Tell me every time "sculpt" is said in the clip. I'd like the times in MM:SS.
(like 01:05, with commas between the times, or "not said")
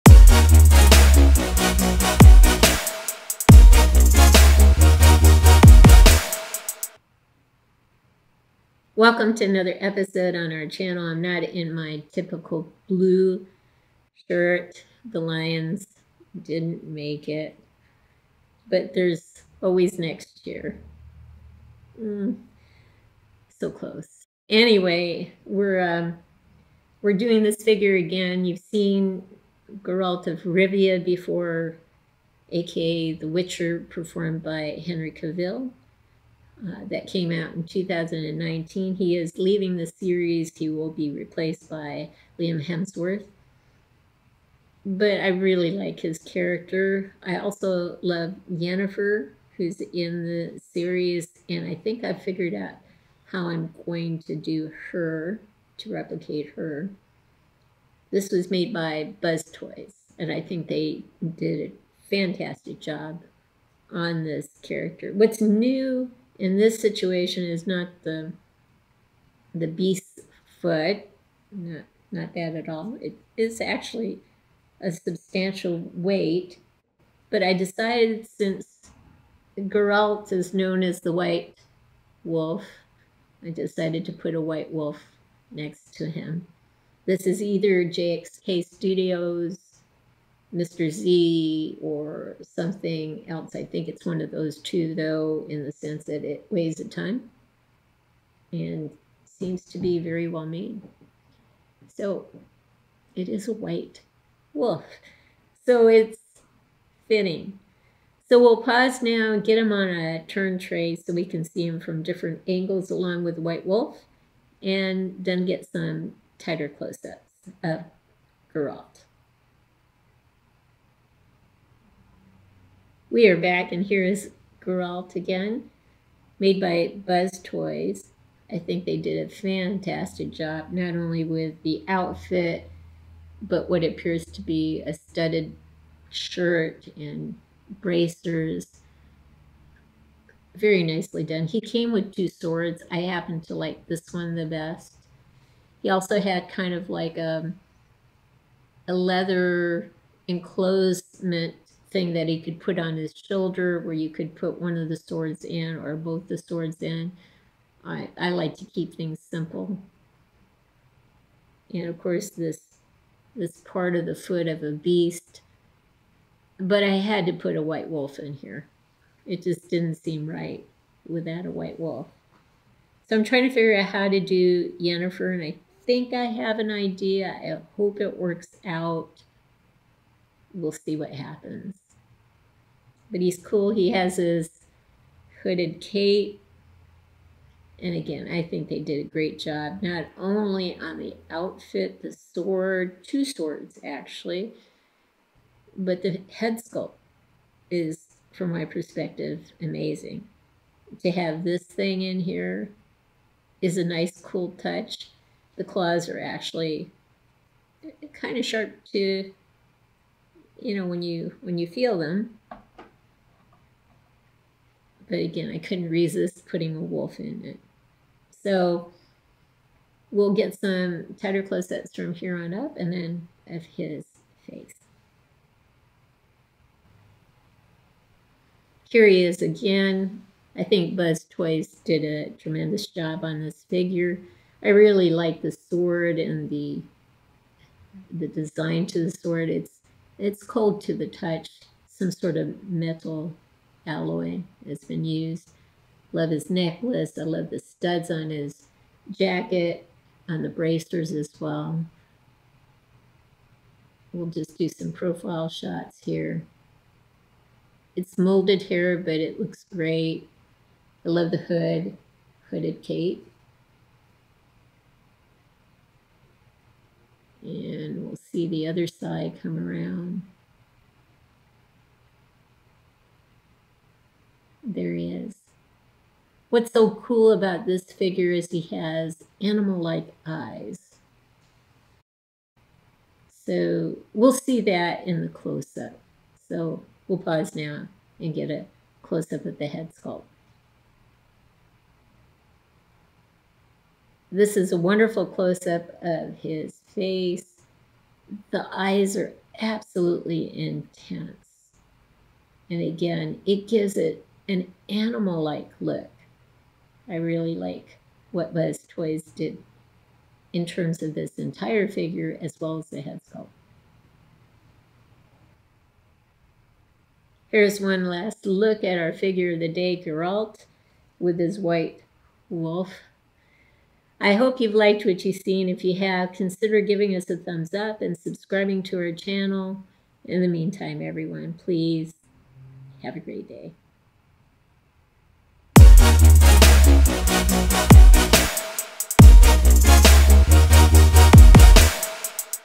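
03:16, 04:49, 05:13.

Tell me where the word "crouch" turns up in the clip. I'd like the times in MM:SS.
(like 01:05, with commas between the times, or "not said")
not said.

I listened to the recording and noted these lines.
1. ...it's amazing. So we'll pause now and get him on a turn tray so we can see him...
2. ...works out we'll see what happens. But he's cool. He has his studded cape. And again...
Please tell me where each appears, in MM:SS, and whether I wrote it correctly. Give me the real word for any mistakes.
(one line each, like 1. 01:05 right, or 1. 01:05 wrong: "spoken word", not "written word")
1. 01:45 wrong: "fitting", not "amazing"
2. 02:58 wrong: "hooded", not "studded".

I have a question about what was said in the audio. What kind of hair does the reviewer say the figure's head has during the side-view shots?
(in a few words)
Molded hair.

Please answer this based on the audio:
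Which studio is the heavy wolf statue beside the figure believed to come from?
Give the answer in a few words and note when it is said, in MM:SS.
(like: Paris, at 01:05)
JXK Studios, at 01:27.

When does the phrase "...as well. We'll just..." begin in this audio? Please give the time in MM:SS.
04:11.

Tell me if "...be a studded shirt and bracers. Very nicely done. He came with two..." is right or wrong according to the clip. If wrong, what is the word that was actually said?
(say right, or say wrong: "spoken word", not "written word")
right.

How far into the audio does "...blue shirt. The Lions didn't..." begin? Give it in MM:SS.
00:12.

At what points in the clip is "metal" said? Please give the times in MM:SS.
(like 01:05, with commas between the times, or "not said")
04:02.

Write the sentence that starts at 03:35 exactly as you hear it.
But again, I couldn't resist putting a wolf in it.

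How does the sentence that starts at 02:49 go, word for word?
It just didn't seem right without a white wolf.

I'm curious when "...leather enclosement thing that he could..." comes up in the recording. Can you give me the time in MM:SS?
02:28.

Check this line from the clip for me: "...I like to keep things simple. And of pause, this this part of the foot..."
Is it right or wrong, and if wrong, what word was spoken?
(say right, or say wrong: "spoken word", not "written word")
wrong: "course", not "pause".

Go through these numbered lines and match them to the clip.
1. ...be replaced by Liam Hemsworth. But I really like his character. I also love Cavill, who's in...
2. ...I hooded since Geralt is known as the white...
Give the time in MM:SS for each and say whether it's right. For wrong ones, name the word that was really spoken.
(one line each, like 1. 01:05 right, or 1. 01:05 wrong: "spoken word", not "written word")
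1. 00:40 wrong: "Yennefer", not "Cavill"
2. 01:17 wrong: "decided", not "hooded".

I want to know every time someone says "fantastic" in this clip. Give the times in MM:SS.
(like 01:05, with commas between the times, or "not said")
01:02, 02:09.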